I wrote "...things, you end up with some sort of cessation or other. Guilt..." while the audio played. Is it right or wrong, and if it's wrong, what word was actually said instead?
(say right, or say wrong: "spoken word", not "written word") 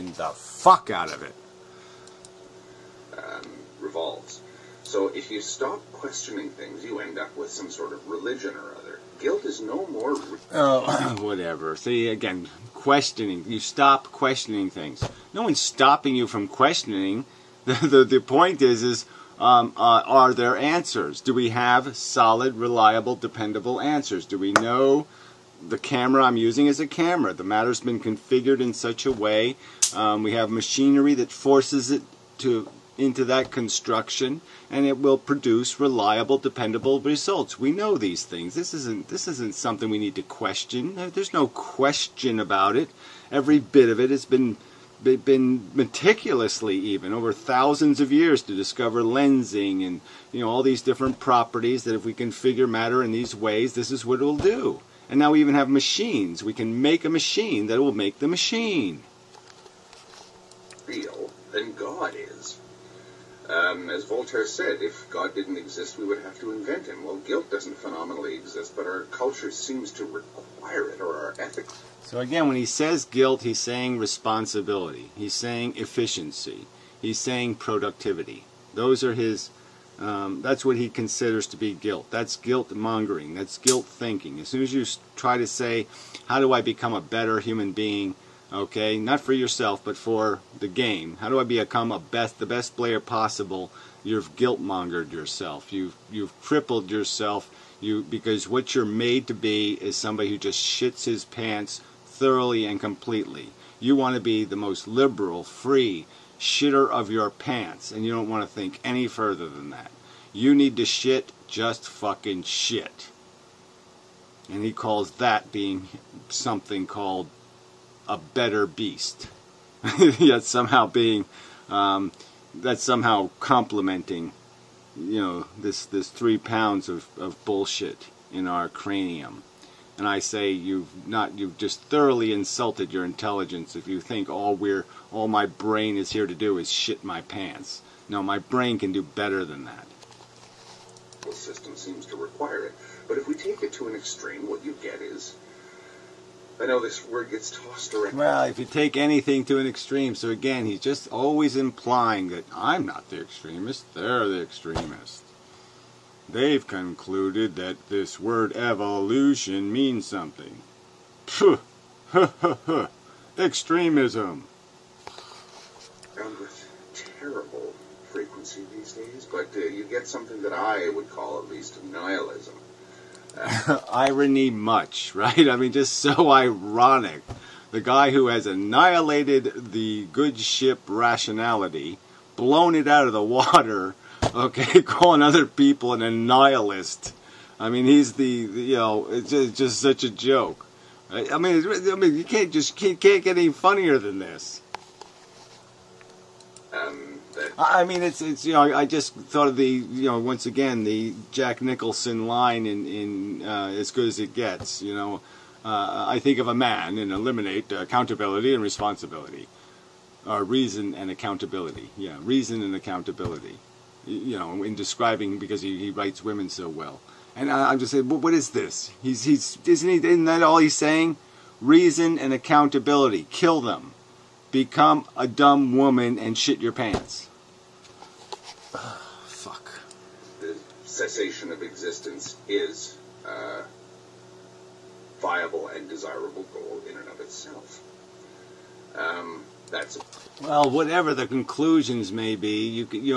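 wrong: "religion", not "cessation".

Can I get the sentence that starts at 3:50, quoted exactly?
The cessation of existence is a viable and desirable goal in and of itself.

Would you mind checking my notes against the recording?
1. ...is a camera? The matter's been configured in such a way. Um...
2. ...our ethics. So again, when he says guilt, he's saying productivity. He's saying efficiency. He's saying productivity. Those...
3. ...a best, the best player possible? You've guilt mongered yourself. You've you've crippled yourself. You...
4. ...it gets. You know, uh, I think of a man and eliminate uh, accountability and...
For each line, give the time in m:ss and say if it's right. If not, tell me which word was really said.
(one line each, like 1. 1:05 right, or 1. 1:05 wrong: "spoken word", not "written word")
1. 0:26 right
2. 1:11 wrong: "responsibility", not "productivity"
3. 1:31 right
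4. 3:24 right.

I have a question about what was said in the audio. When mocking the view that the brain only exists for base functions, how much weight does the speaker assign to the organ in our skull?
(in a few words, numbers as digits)
3 pounds.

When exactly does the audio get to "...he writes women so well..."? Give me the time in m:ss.
3:35.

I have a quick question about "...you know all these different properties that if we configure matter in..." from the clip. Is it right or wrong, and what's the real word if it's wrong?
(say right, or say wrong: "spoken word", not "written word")
right.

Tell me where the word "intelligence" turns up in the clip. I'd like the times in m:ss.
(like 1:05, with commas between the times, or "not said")
2:13.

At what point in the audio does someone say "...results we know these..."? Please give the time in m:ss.
0:37.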